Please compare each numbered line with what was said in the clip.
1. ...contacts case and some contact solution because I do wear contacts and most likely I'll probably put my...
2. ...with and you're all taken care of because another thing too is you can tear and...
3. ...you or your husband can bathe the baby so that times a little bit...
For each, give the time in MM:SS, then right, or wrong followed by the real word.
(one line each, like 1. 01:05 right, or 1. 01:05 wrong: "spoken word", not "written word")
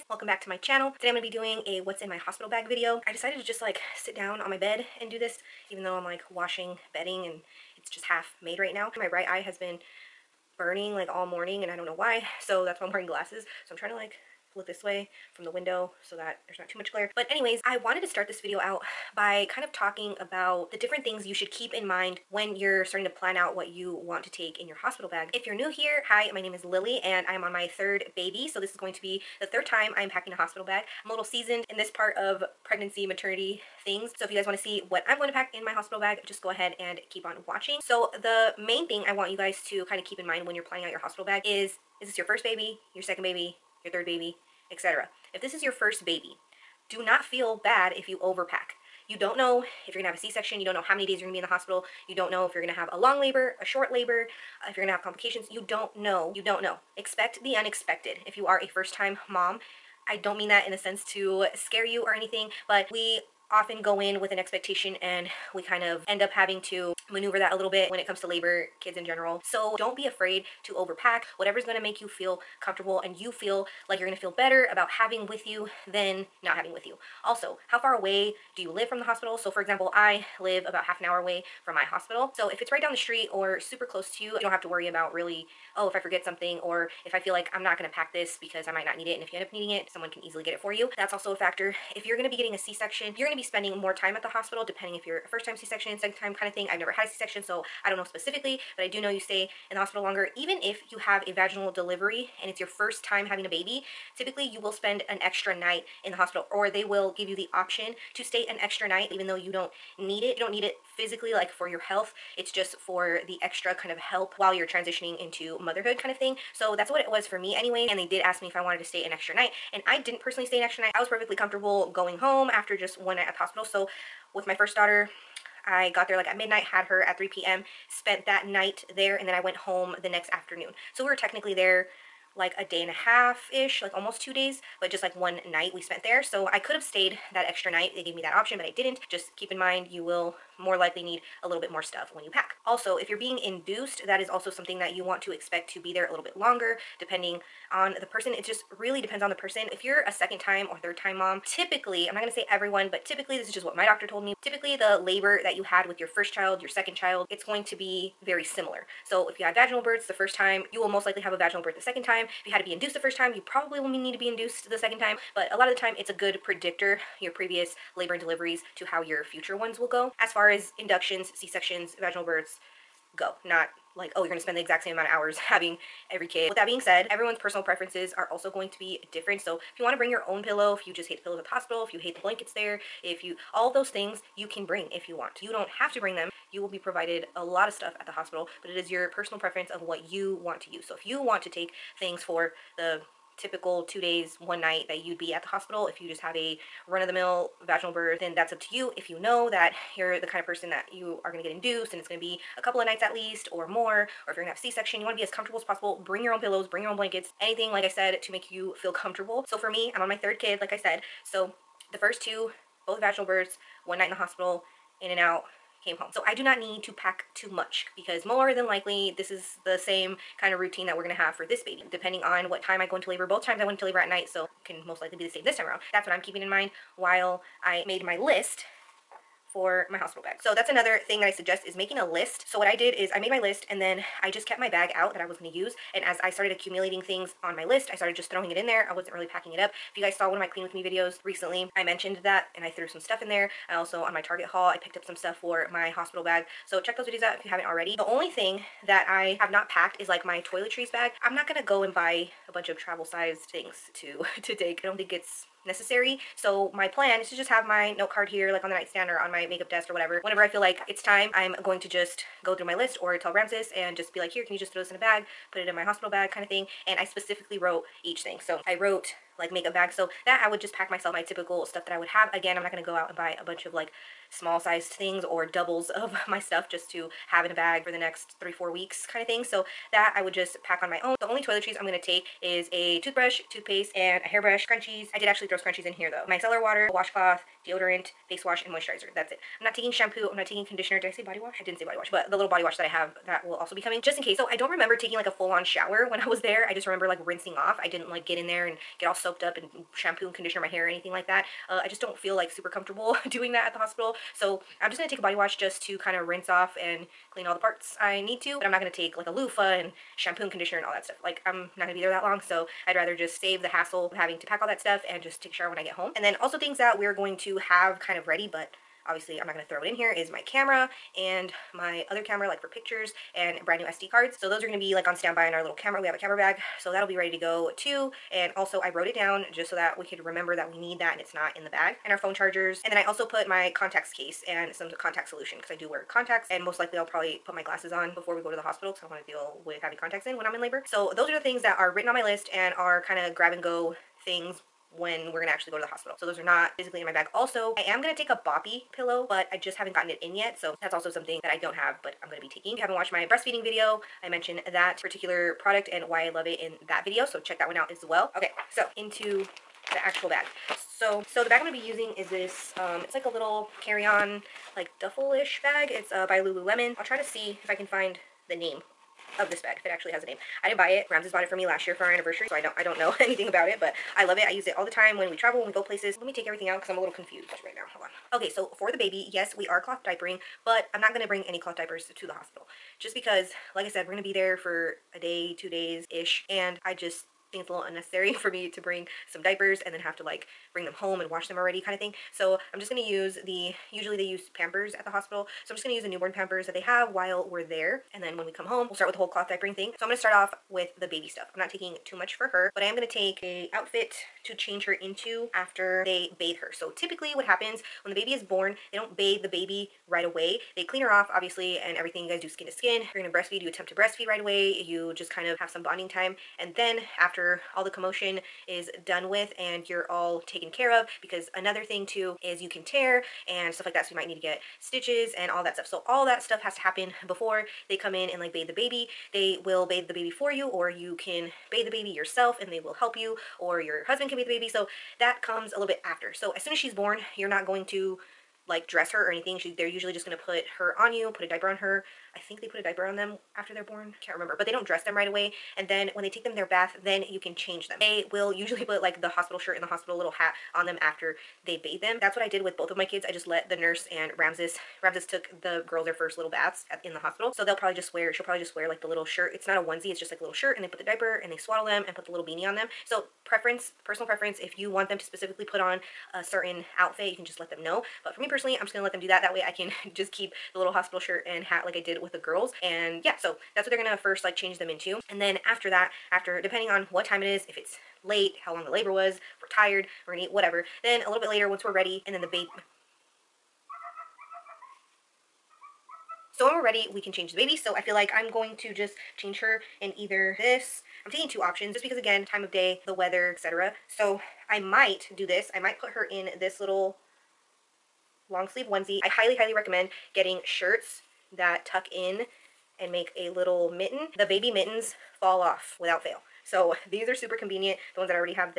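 1. 05:33 right
2. 06:59 right
3. 07:13 wrong: "comes", not "times".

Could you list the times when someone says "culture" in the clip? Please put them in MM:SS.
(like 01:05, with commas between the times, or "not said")
not said.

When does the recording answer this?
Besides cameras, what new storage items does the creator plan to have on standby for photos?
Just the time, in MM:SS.
05:23.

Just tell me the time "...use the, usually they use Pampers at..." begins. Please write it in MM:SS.
06:33.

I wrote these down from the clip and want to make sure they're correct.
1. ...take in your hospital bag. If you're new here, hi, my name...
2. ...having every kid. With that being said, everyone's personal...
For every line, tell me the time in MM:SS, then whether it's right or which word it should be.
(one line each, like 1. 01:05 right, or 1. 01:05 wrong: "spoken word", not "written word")
1. 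00:24 right
2. 02:55 right.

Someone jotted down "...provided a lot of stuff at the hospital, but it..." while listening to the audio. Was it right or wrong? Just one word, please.
right.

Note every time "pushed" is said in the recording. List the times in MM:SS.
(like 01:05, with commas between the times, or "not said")
not said.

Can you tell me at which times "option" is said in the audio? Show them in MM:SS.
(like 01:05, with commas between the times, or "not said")
01:47, 02:18, 08:11.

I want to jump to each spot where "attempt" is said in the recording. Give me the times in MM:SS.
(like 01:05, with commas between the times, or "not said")
06:53.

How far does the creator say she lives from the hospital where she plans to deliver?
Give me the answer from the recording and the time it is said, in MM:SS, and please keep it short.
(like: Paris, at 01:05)
half an hour, at 01:20.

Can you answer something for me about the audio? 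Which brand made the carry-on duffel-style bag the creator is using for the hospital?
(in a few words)
Lululemon.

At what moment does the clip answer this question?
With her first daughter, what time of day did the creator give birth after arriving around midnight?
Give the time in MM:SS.
02:07.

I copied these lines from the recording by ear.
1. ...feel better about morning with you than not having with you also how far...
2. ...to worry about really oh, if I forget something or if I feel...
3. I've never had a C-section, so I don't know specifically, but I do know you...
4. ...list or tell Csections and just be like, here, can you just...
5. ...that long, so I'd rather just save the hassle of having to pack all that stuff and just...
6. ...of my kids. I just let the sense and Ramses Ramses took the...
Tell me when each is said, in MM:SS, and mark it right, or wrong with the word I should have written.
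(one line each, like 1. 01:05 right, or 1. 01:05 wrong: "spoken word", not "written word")
1. 01:14 wrong: "having", not "morning"
2. 01:24 right
3. 01:36 right
4. 04:22 wrong: "Ramses", not "Csections"
5. 05:12 right
6. 07:32 wrong: "nurse", not "sense".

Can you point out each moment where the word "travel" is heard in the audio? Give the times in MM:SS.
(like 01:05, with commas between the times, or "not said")
04:12, 06:15.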